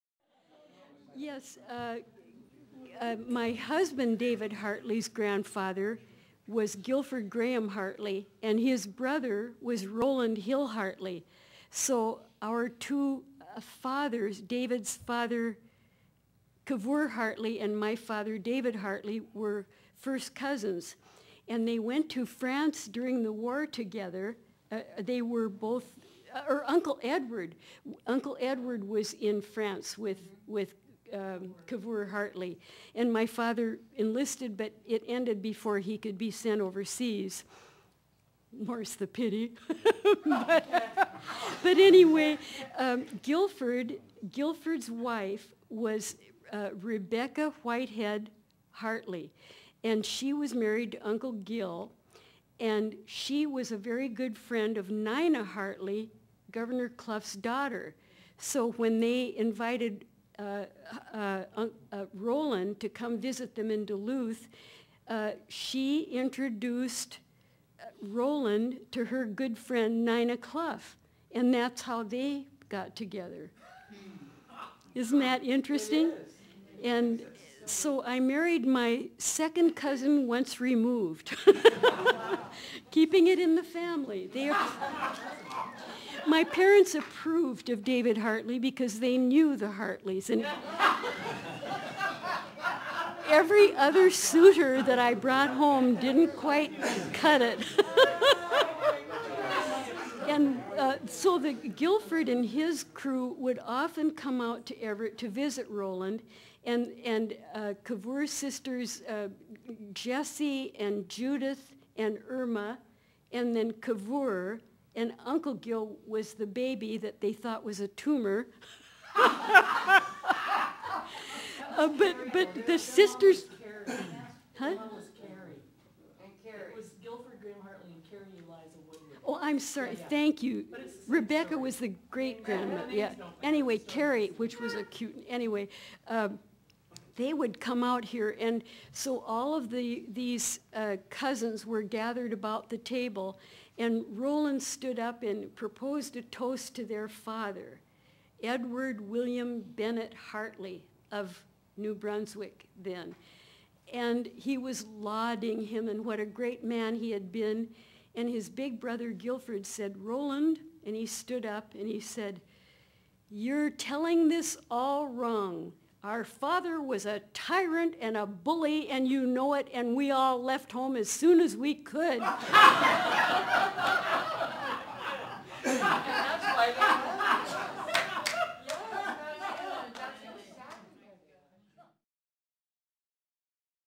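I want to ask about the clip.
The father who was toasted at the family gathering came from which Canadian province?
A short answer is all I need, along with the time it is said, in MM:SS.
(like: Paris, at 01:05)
New Brunswick, at 02:31.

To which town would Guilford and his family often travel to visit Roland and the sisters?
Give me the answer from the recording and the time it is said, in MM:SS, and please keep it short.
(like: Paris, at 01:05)
Everett, at 01:44.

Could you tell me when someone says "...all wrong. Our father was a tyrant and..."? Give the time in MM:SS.
02:44.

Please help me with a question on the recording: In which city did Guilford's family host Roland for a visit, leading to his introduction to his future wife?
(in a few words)
Duluth.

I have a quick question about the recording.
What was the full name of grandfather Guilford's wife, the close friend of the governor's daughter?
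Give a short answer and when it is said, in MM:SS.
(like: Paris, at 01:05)
Rebecca Whitehead Hartley, at 00:46.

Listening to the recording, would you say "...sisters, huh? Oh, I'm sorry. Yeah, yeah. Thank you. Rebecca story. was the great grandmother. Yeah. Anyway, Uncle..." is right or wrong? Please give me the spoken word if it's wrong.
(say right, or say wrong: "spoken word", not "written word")
wrong: "Carrie", not "Uncle".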